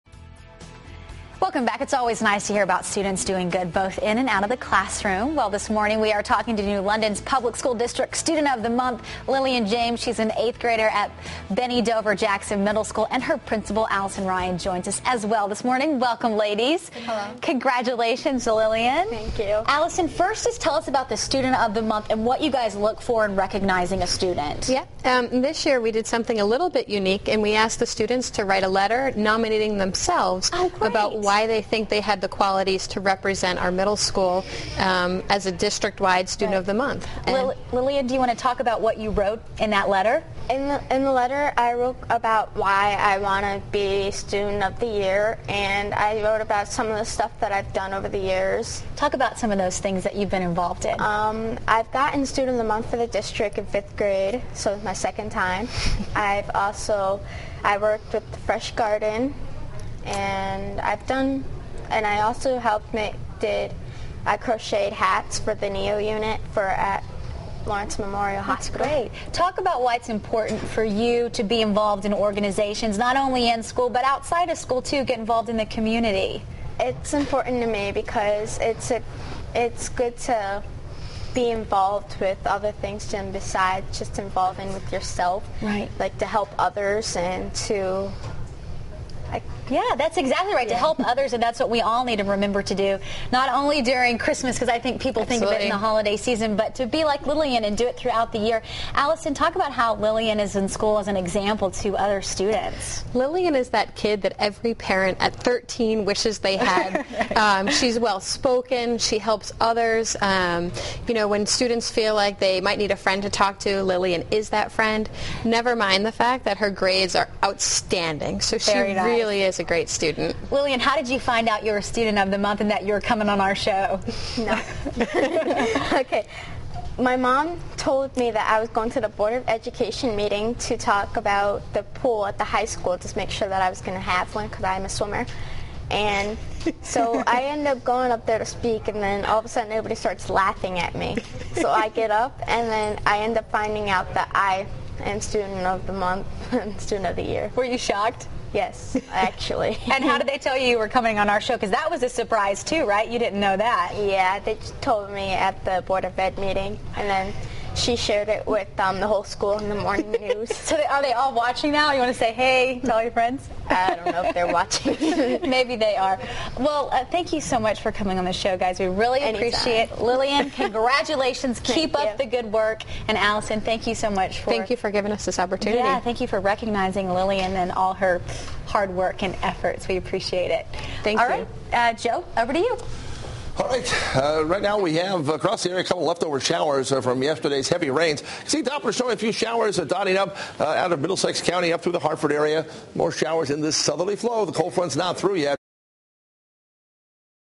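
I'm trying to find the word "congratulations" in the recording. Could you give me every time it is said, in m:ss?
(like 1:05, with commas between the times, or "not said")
0:17, 2:50.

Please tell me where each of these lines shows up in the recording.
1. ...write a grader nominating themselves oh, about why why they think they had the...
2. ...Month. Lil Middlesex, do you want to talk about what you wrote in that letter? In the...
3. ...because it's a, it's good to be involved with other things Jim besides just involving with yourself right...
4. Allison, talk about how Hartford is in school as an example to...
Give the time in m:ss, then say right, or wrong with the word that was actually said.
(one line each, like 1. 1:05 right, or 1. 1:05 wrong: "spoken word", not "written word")
1. 0:28 wrong: "letter", not "grader"
2. 0:36 wrong: "Lilia", not "Middlesex"
3. 1:17 right
4. 1:38 wrong: "Lillian", not "Hartford".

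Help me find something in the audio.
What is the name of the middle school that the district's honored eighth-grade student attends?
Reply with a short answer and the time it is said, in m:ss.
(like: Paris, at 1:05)
Bennie Dover Jackson Middle School, at 0:11.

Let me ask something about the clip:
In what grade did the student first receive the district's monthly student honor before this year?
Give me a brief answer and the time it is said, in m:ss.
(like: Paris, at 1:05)
fifth grade, at 0:53.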